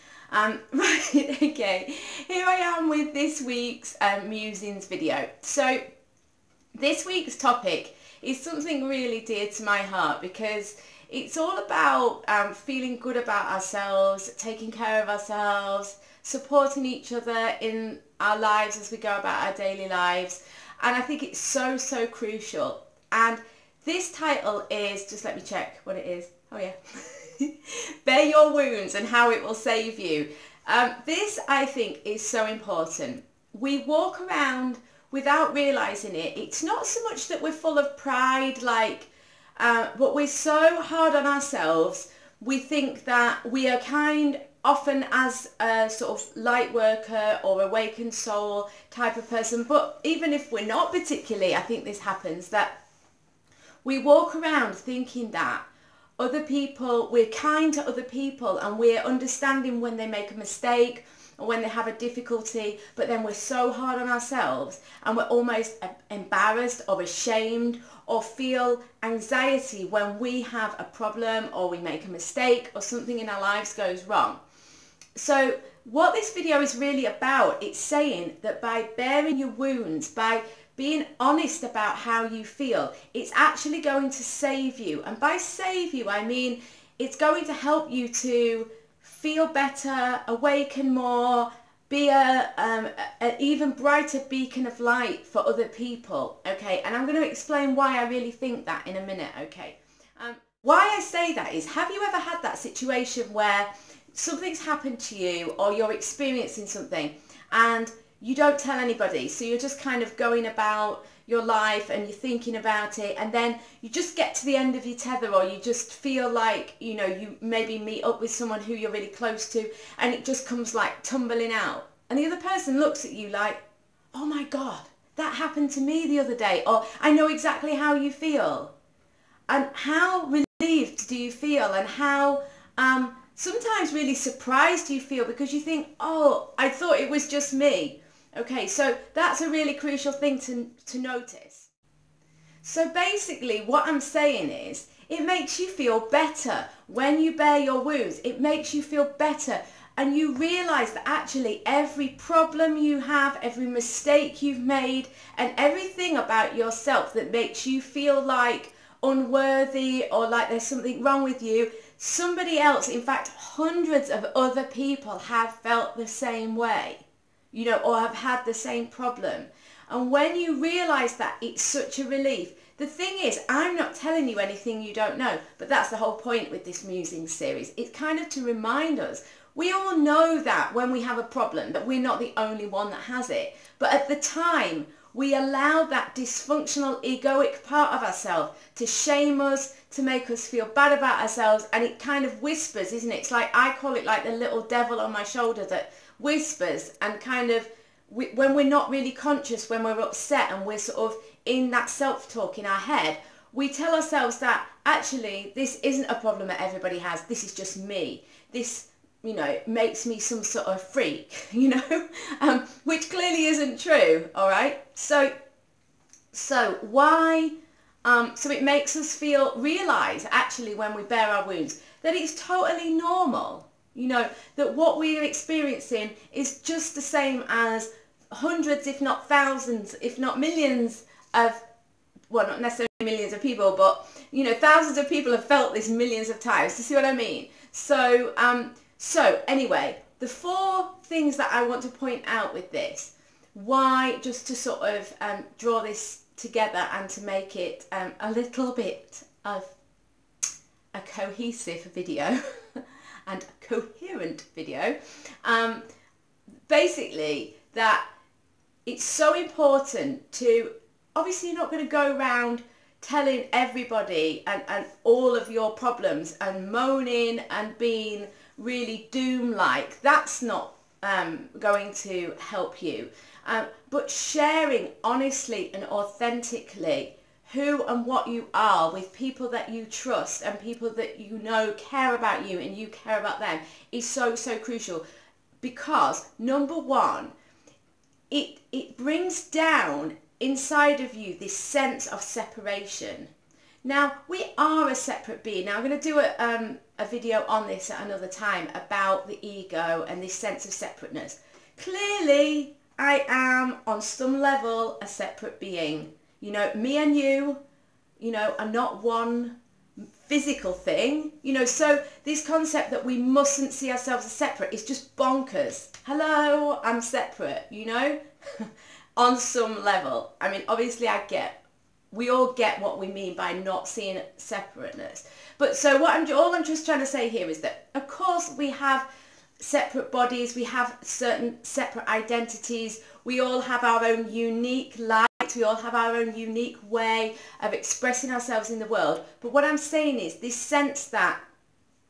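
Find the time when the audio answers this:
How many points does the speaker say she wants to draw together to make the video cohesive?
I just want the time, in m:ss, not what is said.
4:00.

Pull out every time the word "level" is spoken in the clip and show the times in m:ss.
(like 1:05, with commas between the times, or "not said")
5:04, 5:19.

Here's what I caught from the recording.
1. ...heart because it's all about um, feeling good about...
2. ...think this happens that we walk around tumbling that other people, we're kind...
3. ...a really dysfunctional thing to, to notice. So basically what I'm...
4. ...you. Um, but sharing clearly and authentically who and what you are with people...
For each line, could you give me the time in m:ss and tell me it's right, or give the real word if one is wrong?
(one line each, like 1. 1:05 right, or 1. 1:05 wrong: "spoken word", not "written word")
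1. 0:09 right
2. 0:51 wrong: "thinking", not "tumbling"
3. 2:19 wrong: "crucial", not "dysfunctional"
4. 4:32 wrong: "honestly", not "clearly".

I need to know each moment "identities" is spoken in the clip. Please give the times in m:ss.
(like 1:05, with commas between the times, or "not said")
5:32.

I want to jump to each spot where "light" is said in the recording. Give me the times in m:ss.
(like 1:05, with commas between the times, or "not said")
0:46, 1:34, 5:34.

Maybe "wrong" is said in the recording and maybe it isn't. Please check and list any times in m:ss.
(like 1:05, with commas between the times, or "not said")
1:14, 2:41.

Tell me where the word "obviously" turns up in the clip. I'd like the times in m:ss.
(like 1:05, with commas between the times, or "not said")
4:21, 5:20.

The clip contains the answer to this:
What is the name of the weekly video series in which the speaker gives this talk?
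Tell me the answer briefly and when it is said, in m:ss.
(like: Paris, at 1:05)
Musings, at 0:04.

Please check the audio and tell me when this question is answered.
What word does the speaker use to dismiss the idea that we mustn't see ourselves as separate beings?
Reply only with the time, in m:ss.
5:15.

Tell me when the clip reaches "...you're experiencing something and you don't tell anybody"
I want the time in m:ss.
1:45.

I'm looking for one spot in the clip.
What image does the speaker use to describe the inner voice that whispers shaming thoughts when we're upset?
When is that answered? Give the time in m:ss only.
3:14.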